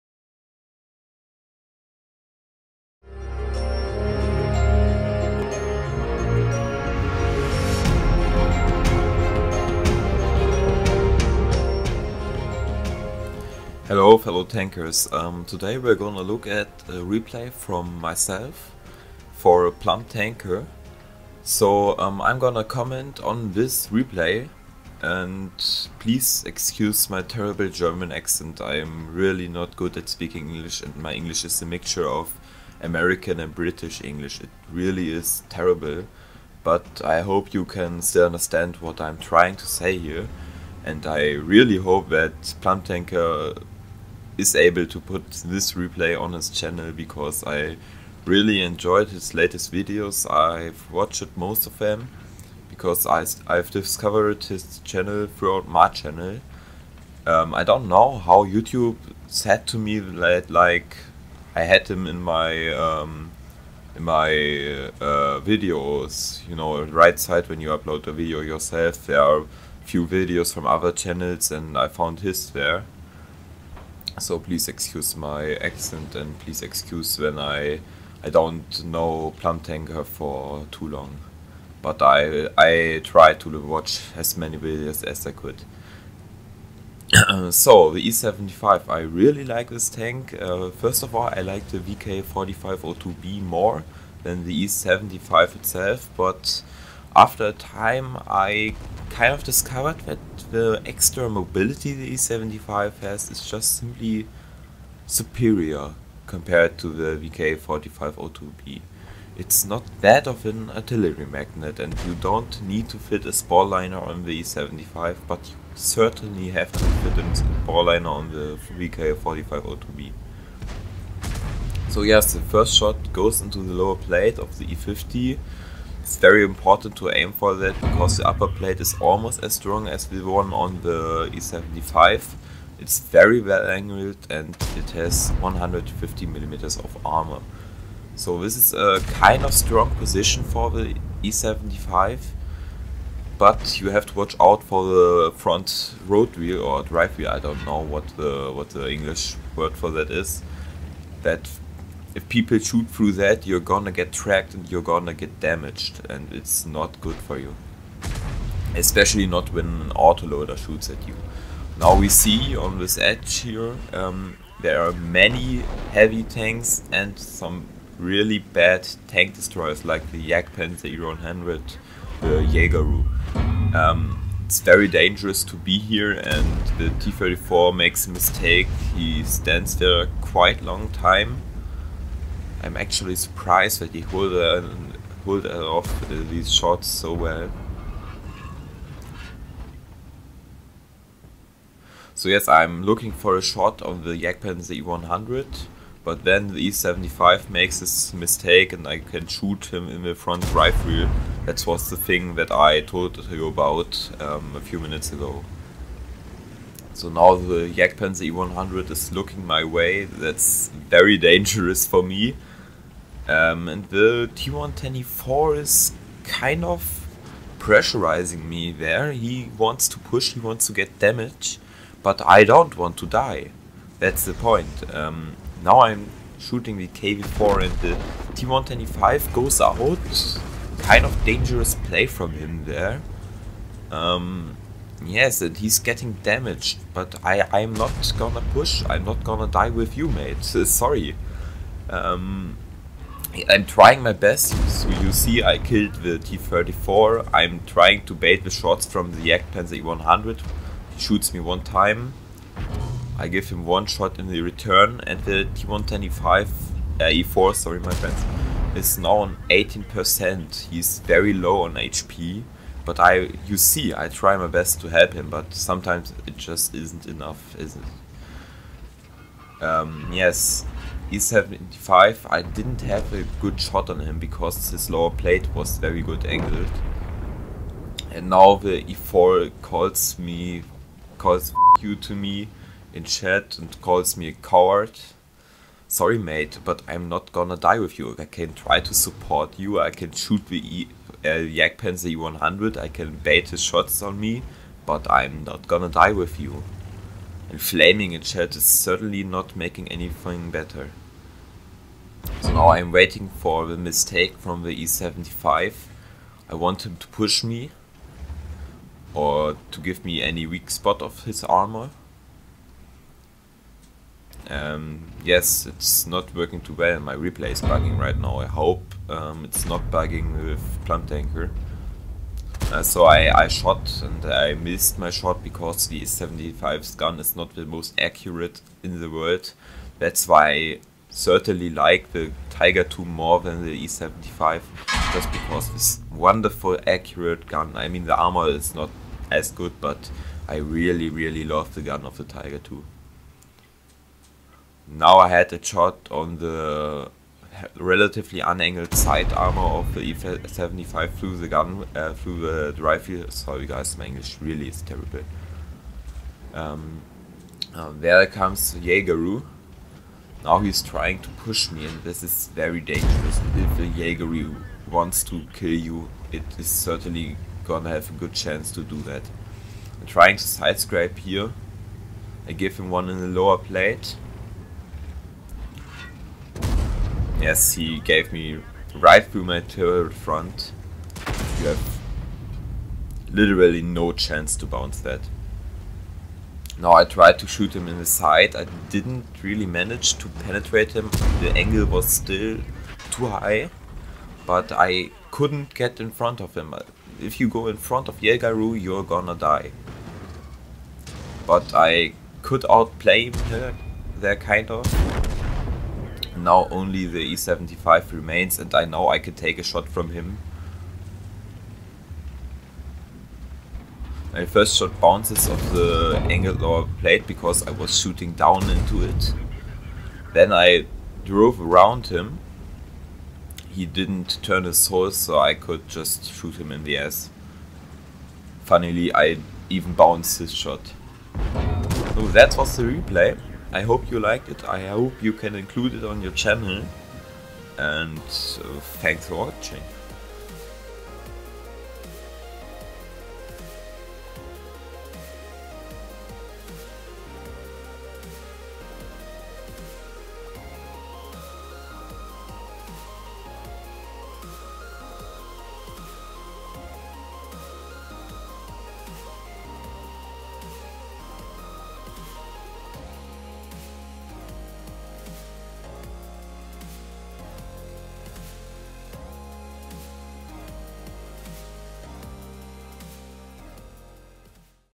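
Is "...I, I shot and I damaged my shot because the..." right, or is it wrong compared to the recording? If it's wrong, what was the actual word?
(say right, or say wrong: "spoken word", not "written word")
wrong: "missed", not "damaged".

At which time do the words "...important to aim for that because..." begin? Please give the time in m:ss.
2:06.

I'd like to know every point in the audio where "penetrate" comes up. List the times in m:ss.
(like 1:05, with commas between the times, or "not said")
6:30.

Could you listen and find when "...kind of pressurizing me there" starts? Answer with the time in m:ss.
3:36.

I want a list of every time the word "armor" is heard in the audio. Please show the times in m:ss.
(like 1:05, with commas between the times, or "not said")
2:17, 5:11, 5:38, 5:49.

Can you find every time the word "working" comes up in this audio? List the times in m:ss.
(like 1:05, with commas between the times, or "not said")
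5:16.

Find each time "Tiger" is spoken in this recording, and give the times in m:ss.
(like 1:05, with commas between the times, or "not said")
5:32, 5:42.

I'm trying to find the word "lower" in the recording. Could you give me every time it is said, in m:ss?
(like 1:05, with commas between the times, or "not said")
2:03, 4:34, 6:13, 6:56.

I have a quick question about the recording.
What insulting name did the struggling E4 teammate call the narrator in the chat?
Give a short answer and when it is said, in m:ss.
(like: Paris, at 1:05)
coward, at 4:44.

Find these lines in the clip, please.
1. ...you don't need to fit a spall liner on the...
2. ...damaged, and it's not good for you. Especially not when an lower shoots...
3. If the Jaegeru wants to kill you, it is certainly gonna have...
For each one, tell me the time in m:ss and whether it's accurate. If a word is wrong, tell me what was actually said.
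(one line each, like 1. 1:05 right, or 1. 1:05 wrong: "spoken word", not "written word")
1. 1:52 right
2. 2:35 wrong: "autoloader", not "lower"
3. 6:03 right.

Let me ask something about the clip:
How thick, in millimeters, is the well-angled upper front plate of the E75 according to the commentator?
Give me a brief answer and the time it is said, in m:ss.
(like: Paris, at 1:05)
150, at 2:15.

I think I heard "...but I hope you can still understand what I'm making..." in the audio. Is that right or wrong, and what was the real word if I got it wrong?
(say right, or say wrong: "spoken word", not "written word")
wrong: "trying", not "making".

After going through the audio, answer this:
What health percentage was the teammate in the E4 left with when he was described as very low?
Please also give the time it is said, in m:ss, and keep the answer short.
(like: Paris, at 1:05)
18%, at 4:19.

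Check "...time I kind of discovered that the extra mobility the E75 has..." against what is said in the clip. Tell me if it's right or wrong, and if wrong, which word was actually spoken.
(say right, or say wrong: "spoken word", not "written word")
right.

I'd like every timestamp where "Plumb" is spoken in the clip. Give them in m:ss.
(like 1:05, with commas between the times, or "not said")
0:19, 0:42, 5:20.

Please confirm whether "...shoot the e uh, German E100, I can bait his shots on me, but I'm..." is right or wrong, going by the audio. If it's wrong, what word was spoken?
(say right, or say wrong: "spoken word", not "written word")
wrong: "Jagd", not "German".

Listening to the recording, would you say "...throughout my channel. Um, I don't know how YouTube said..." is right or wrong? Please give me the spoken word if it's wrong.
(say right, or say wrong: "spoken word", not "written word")
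right.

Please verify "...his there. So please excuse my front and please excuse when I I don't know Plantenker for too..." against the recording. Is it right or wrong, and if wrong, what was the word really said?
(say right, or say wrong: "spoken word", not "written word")
wrong: "accent", not "front".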